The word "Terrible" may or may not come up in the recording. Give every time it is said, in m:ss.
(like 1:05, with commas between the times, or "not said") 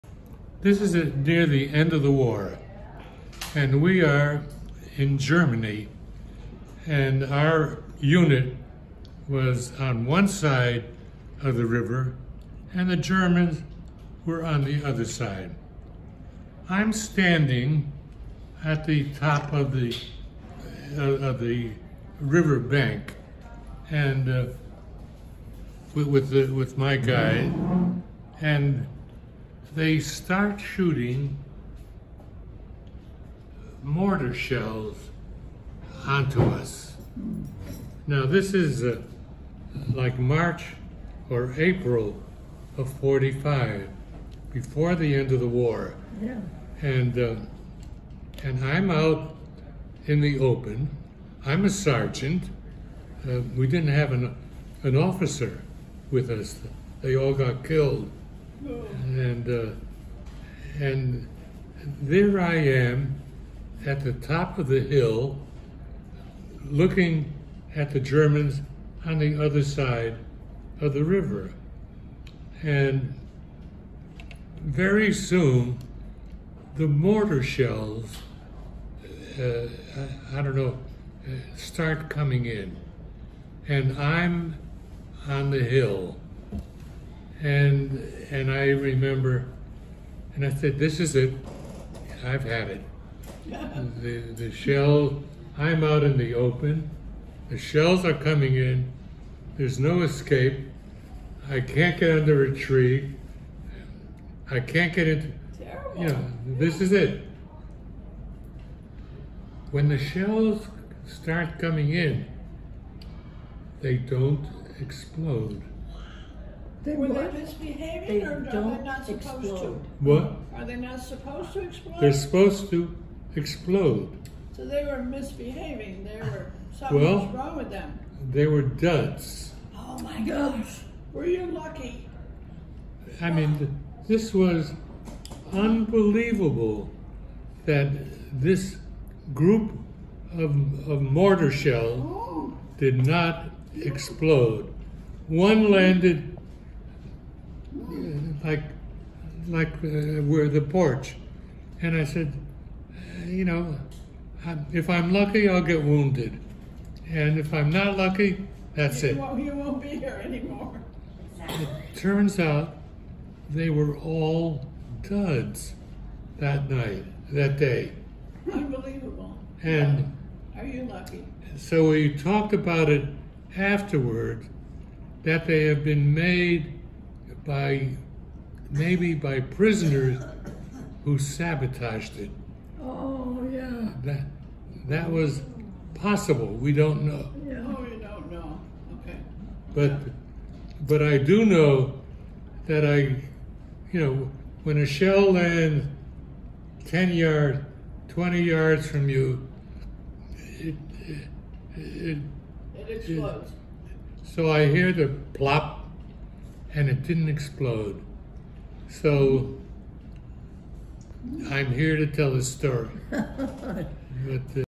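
1:45.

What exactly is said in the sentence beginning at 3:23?
It, so I hear the plop, and it didn't explode.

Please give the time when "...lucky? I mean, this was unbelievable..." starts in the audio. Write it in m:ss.
2:11.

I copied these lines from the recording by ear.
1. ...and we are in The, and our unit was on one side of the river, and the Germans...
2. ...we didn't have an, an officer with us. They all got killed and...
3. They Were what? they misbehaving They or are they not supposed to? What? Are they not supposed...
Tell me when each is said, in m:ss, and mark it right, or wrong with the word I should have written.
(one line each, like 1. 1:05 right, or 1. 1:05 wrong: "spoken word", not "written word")
1. 0:03 wrong: "Germany", not "The"
2. 0:53 right
3. 1:56 right.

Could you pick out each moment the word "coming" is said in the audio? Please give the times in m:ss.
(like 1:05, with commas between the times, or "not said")
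1:22, 1:38, 1:51.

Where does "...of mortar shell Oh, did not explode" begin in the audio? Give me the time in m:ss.
2:20.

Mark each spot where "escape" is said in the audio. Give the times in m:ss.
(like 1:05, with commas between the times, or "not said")
1:40.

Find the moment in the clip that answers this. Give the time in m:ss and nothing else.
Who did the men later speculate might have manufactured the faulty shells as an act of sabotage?
2:59.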